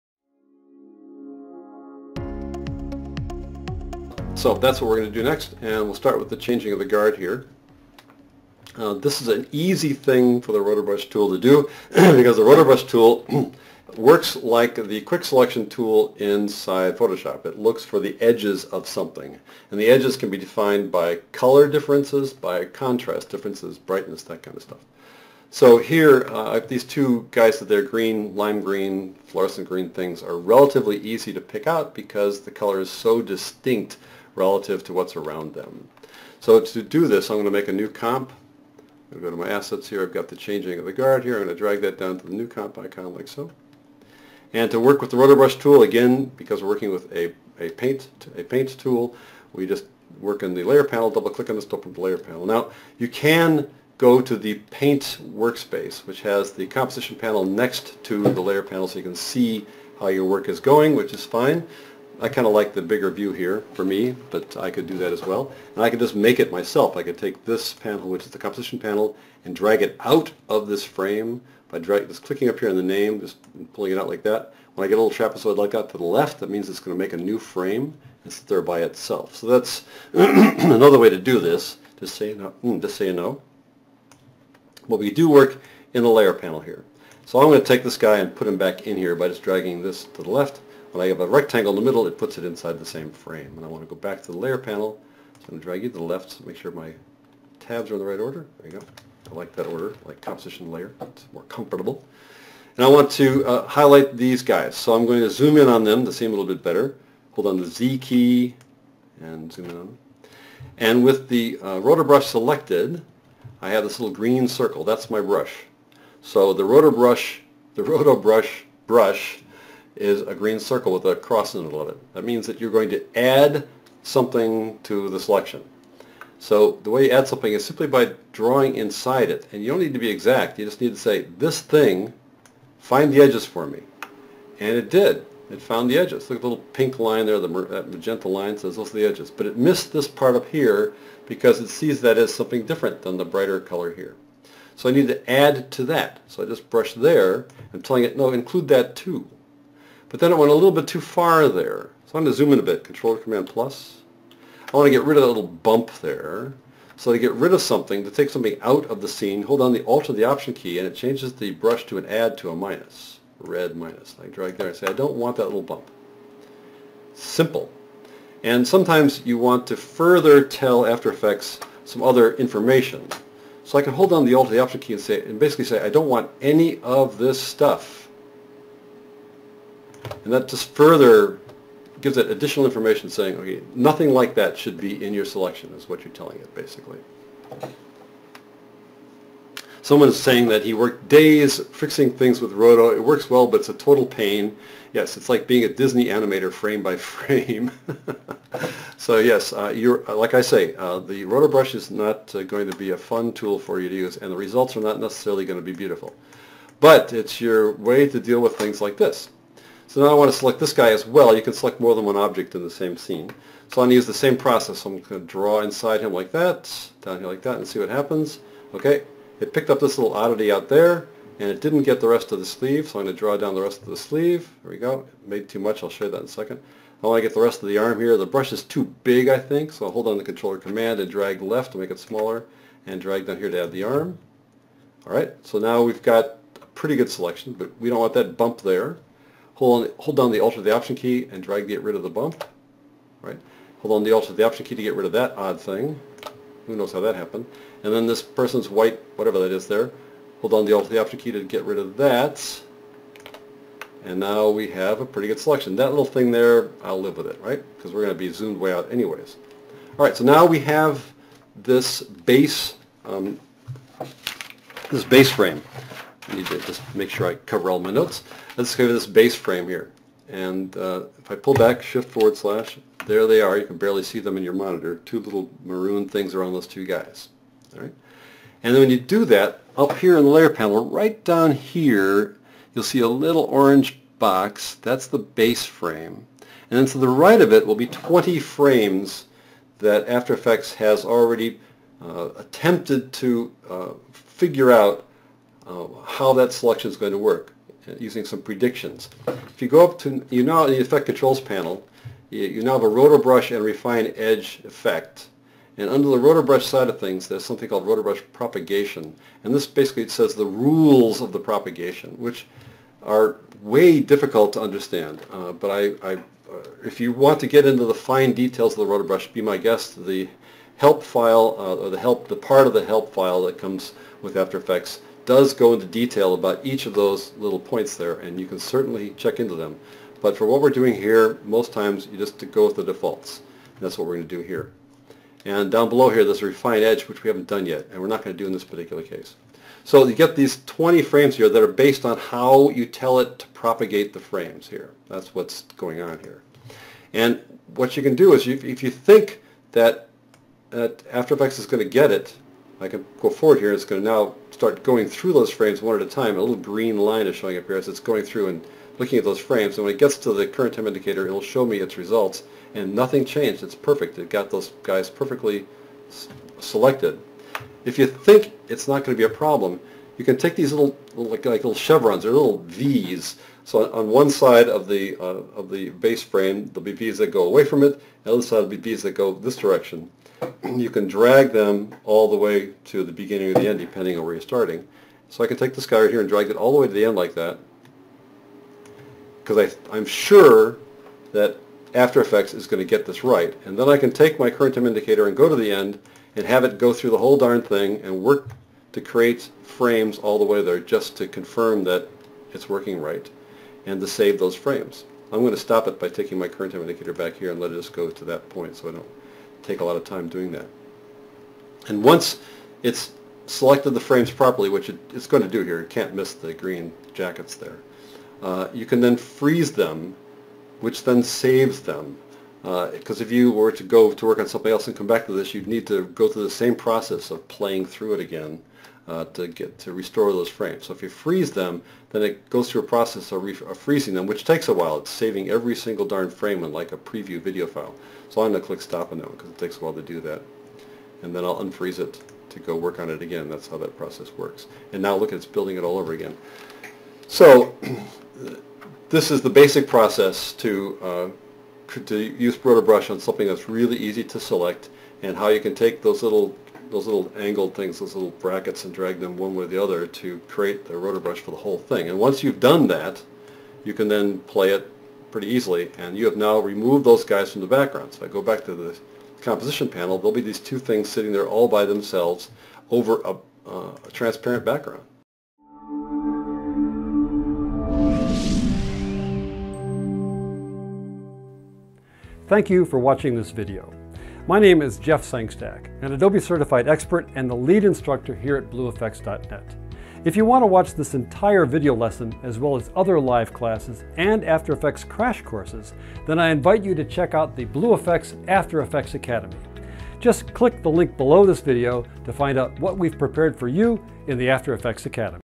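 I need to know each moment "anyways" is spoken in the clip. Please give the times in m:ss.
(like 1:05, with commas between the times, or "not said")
4:18.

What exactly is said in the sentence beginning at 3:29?
So now I want to select this guy as well.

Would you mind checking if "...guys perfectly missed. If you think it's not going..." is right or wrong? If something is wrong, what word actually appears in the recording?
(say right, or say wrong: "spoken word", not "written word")
wrong: "selected", not "missed".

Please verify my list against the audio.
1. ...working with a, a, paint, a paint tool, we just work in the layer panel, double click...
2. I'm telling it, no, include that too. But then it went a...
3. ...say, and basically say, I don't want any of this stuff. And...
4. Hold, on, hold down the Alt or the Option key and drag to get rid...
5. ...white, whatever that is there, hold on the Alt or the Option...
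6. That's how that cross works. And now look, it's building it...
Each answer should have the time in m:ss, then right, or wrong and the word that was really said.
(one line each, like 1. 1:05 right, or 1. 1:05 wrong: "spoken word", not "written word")
1. 0:46 right
2. 2:27 right
3. 2:55 right
4. 3:59 right
5. 4:08 right
6. 7:23 wrong: "process", not "cross".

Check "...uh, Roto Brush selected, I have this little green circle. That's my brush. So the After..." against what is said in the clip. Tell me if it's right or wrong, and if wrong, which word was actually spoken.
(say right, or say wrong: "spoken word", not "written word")
wrong: "Roto", not "After".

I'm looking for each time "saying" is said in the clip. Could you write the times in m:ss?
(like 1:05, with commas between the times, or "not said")
3:03, 3:10.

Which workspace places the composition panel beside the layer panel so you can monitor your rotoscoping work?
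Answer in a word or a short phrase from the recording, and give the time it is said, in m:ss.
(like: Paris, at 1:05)
Paint workspace, at 0:54.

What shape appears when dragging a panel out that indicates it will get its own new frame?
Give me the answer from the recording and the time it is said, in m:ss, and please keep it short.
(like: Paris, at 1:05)
Trapezoid, at 1:15.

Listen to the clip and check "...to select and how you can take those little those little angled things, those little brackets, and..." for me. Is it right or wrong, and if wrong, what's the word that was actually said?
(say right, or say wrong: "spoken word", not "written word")
right.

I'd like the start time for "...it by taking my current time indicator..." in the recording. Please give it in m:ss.
6:45.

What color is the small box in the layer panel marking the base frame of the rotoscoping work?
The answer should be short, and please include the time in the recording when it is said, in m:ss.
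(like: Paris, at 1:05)
Orange, at 4:43.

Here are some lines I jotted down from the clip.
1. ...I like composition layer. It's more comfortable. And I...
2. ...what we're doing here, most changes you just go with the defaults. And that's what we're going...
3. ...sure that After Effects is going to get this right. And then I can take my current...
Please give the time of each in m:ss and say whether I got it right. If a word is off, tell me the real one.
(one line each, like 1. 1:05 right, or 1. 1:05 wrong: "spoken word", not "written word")
1. 1:40 right
2. 5:30 wrong: "times", not "changes"
3. 6:30 right.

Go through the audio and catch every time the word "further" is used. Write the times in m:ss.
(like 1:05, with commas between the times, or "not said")
2:49, 3:00.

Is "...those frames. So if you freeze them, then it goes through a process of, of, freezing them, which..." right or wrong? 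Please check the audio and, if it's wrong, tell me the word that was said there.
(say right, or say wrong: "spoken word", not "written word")
right.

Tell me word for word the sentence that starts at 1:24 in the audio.
But we do work in the layer panel here.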